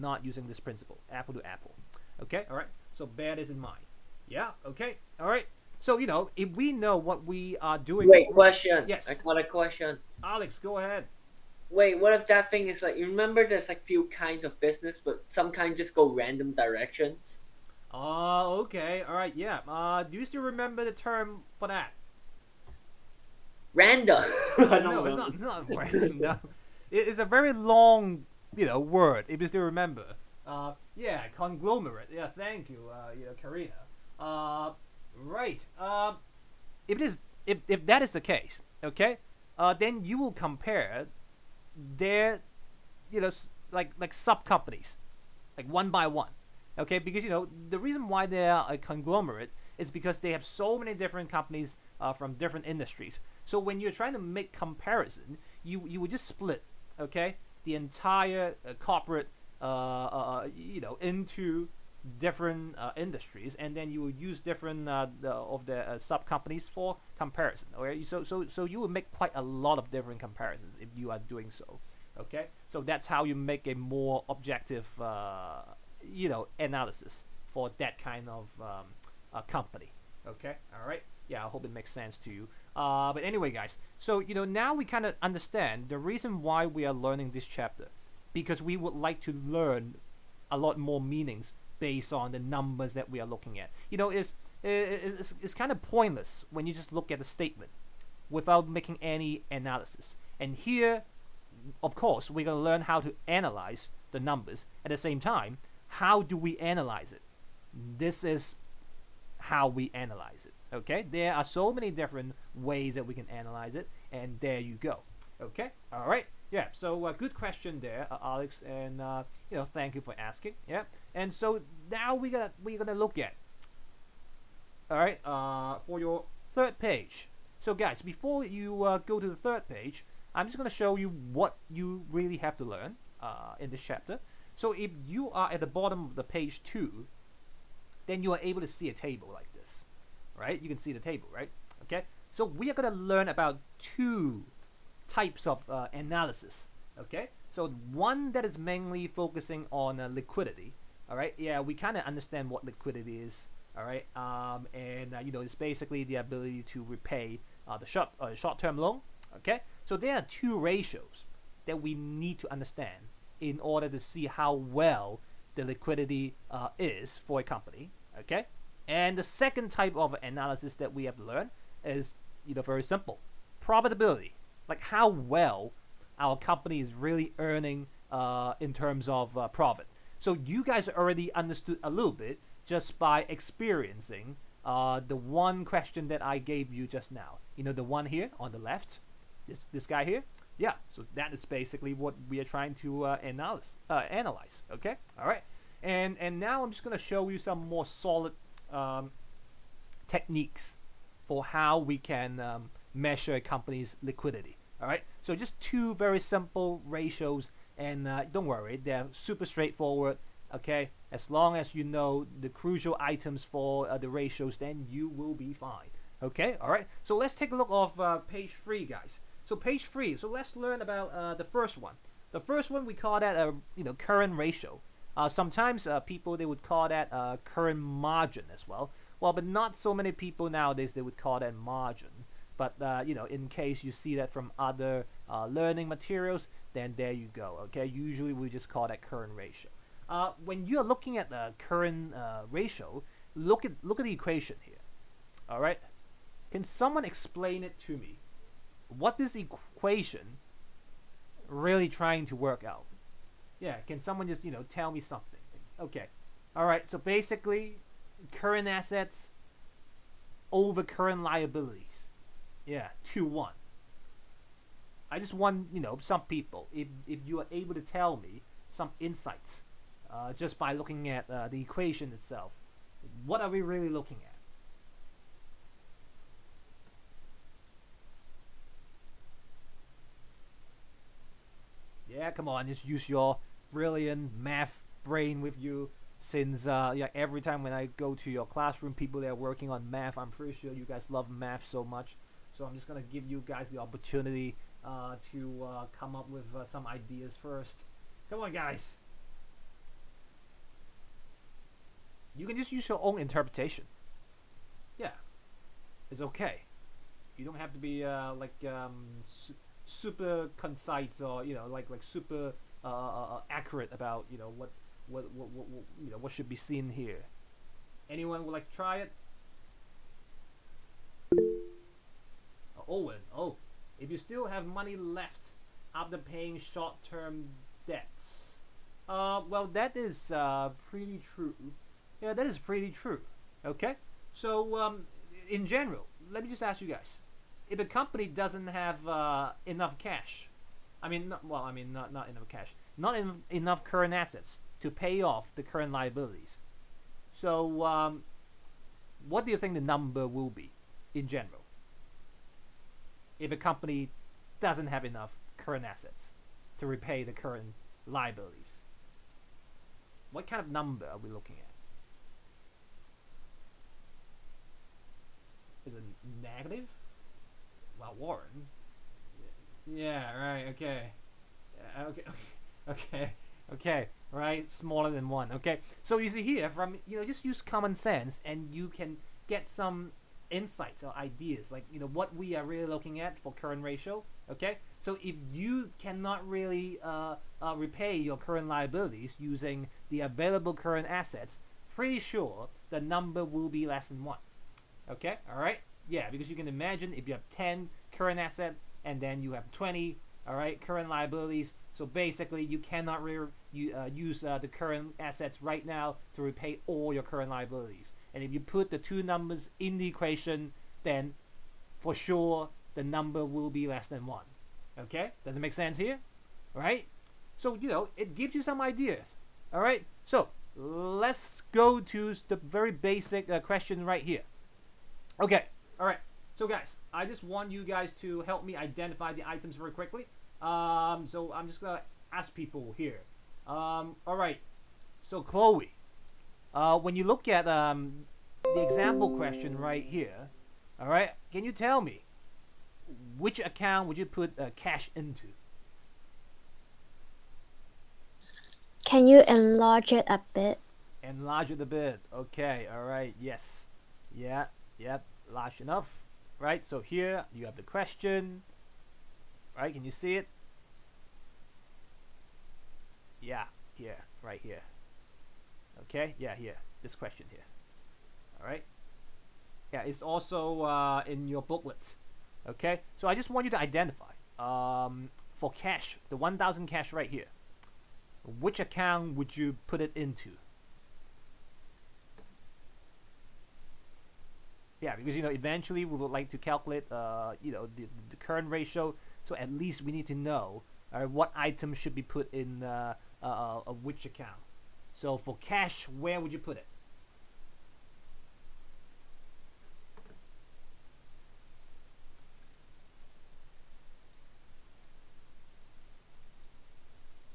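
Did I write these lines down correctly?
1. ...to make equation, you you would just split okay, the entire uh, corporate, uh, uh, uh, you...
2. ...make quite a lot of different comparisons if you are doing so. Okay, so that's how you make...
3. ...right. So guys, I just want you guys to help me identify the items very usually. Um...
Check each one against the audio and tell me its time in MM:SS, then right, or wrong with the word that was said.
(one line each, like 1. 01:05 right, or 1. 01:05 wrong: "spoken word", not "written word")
1. 00:54 wrong: "comparison", not "equation"
2. 01:08 right
3. 07:06 wrong: "quickly", not "usually".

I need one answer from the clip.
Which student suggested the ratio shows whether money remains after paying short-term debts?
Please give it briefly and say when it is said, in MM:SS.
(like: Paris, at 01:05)
Owen, at 05:22.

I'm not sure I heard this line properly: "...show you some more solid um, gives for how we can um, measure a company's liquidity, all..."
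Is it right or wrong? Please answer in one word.
wrong.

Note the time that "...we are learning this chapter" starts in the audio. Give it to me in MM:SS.
01:26.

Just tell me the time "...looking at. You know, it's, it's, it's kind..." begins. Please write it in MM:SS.
01:33.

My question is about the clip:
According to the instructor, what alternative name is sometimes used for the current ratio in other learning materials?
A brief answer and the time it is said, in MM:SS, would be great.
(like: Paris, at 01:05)
Current margin, at 03:47.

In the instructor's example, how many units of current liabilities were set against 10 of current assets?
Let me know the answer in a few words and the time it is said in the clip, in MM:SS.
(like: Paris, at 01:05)
20, at 06:39.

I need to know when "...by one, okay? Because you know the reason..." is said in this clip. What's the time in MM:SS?
00:45.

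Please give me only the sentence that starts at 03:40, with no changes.
So let's learn about uh, the first one.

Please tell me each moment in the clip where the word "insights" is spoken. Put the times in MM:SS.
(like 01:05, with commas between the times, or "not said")
04:28, 06:20.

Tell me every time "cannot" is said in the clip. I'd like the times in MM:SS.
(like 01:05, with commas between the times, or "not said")
06:26, 06:42.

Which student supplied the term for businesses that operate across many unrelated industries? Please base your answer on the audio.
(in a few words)
Karina.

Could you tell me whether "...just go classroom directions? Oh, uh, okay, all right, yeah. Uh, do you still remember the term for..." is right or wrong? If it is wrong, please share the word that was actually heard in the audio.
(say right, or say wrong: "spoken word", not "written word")
wrong: "random", not "classroom".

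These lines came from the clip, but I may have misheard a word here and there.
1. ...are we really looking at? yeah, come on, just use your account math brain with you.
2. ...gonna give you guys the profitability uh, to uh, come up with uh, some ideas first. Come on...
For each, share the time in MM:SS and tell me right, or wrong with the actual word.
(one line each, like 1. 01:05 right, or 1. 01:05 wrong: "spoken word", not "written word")
1. 04:33 wrong: "brilliant", not "account"
2. 04:52 wrong: "opportunity", not "profitability".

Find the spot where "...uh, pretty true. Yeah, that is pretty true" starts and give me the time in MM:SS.
05:30.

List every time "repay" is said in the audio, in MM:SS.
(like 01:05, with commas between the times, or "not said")
02:36, 05:56, 06:27, 06:46.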